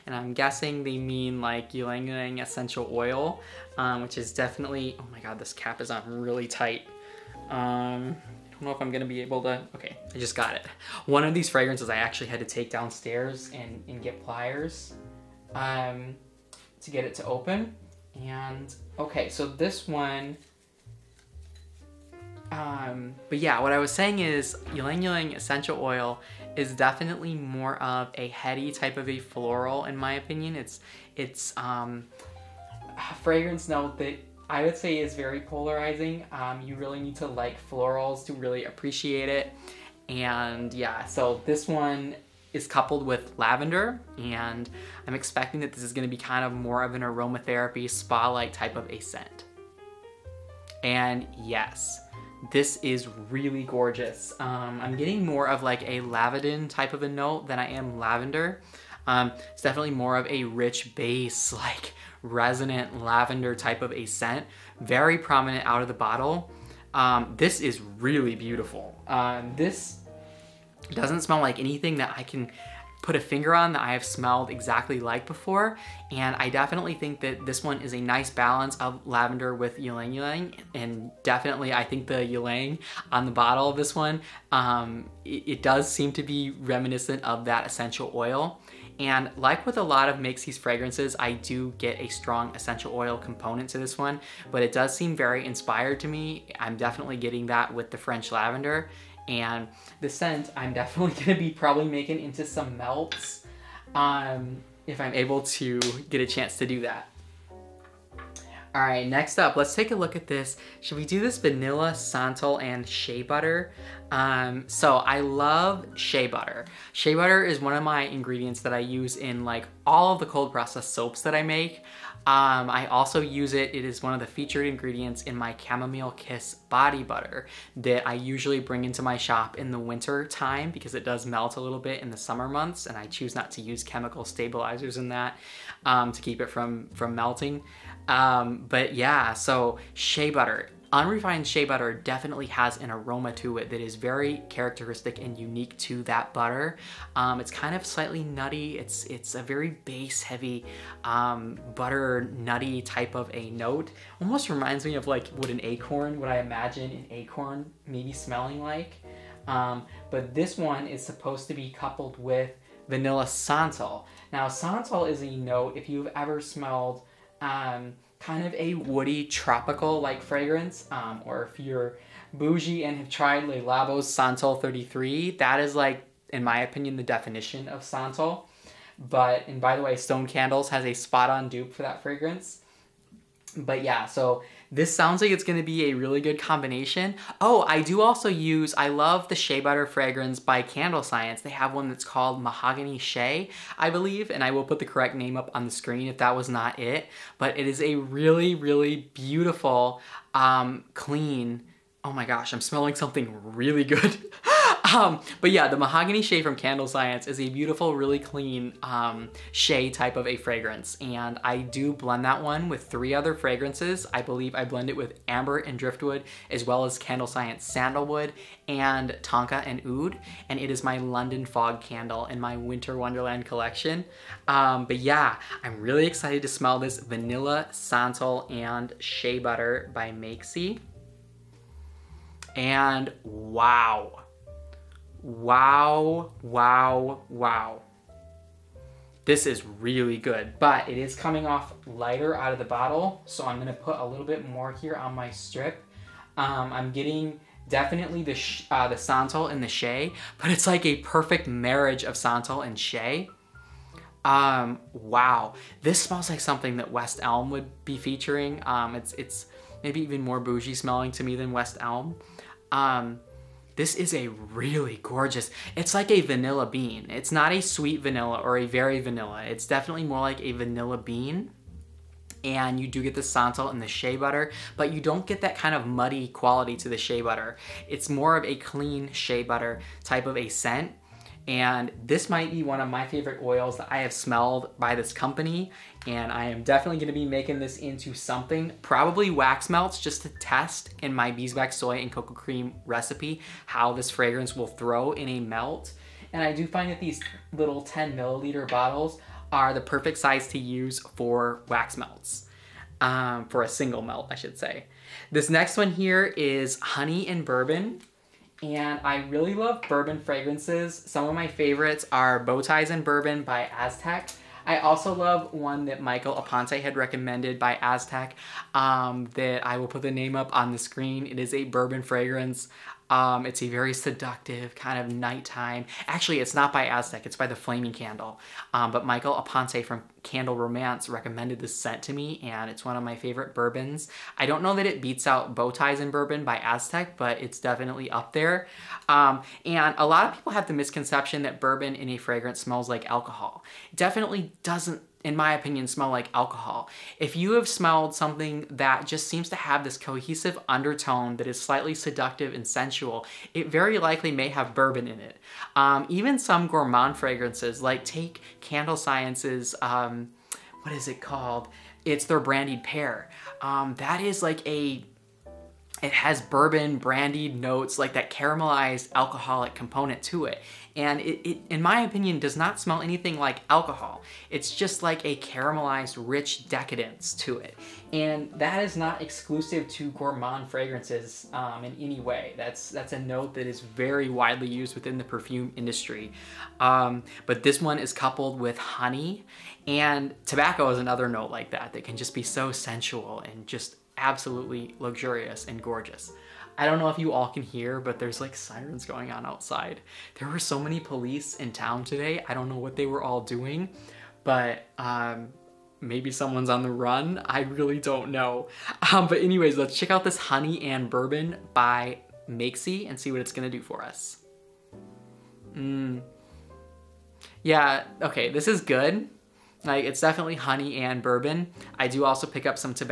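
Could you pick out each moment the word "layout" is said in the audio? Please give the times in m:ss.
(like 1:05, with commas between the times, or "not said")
not said.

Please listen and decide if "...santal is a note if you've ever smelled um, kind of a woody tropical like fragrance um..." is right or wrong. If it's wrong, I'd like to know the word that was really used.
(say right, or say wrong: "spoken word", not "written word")
right.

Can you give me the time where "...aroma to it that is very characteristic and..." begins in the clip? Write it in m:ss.
2:22.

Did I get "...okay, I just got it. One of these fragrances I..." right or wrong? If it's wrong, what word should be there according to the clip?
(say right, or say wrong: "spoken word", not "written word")
right.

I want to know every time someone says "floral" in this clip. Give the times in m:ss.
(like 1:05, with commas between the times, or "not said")
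0:29, 0:37.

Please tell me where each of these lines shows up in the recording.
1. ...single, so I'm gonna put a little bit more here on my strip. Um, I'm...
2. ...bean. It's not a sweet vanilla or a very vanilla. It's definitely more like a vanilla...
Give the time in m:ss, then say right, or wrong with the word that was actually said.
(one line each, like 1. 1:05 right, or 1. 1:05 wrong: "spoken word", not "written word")
1. 4:02 wrong: "bottle", not "single"
2. 4:26 right.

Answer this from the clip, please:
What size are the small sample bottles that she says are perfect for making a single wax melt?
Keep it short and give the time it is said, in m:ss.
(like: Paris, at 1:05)
10 milliliters, at 4:57.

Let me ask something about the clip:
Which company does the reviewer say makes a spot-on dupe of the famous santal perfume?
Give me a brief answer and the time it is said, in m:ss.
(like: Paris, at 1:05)
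Stone Candles, at 2:59.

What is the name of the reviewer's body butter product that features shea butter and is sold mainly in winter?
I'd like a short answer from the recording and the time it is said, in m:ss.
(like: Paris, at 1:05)
Chamomile Kiss, at 2:05.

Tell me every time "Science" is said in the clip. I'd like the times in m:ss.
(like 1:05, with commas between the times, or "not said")
3:11, 3:26, 3:37, 5:58.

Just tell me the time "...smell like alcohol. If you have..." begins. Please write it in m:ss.
5:45.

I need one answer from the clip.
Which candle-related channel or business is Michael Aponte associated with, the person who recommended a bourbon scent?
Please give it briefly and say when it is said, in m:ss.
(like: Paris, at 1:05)
Candle Romance, at 5:30.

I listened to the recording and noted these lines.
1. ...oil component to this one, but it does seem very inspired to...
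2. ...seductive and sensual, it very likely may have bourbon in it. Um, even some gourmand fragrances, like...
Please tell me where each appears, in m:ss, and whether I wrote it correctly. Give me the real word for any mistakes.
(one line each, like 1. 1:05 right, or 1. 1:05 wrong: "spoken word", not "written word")
1. 1:32 right
2. 5:51 right.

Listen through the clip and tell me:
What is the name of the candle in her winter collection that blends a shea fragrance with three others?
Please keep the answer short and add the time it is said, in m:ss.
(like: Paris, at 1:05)
London Fog, at 3:40.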